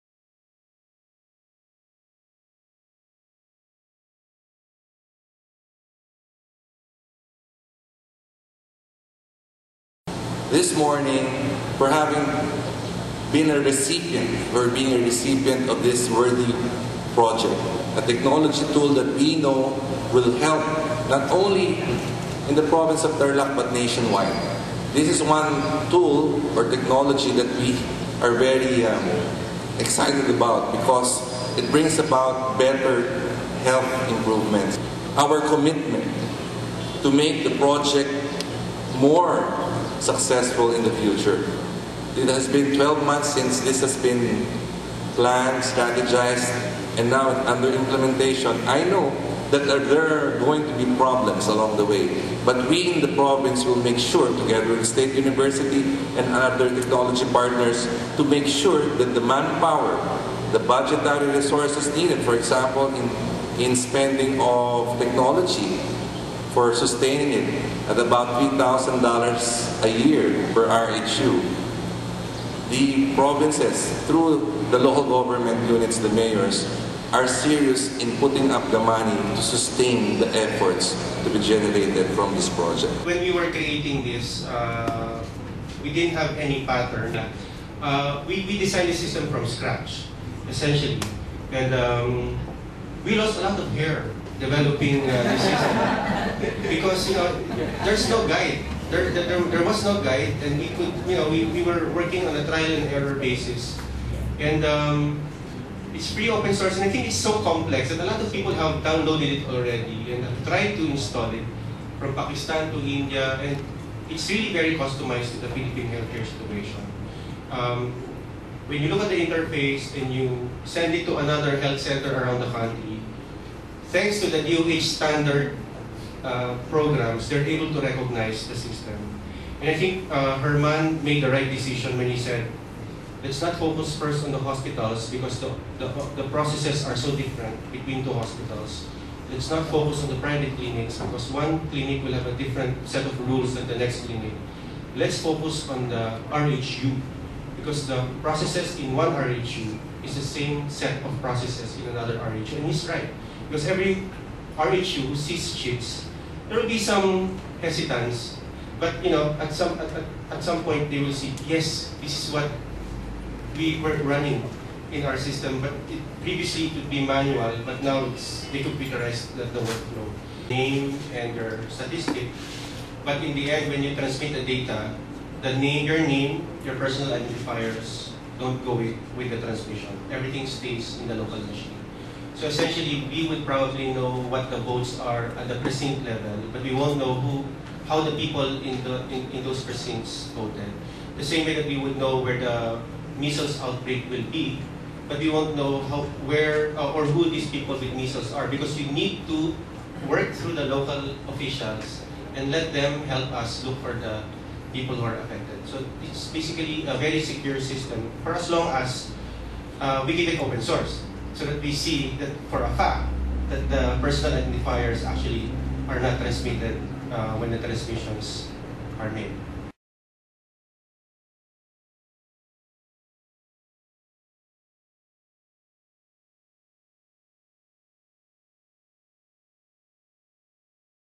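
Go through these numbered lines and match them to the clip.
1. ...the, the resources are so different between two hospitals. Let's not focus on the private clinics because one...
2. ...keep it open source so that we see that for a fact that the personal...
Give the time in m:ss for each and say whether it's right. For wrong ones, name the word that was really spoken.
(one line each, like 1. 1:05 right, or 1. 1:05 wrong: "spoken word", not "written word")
1. 2:15 wrong: "processes", not "resources"
2. 3:30 right.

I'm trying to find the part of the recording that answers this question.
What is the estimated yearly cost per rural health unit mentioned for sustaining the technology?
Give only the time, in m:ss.
1:08.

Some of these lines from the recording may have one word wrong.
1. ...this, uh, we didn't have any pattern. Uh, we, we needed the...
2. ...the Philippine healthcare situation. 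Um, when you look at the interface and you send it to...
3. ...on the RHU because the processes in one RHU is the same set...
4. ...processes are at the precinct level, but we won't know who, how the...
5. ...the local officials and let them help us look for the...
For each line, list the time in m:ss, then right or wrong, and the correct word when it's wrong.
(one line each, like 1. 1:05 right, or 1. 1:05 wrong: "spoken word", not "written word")
1. 1:24 wrong: "designed", not "needed"
2. 1:55 right
3. 2:25 right
4. 3:04 wrong: "votes", not "processes"
5. 3:20 right.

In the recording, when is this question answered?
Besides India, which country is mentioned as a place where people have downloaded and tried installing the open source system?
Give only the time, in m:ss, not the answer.
1:52.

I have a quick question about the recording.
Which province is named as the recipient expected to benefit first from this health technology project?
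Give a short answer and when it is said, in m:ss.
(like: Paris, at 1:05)
Tarlac, at 0:23.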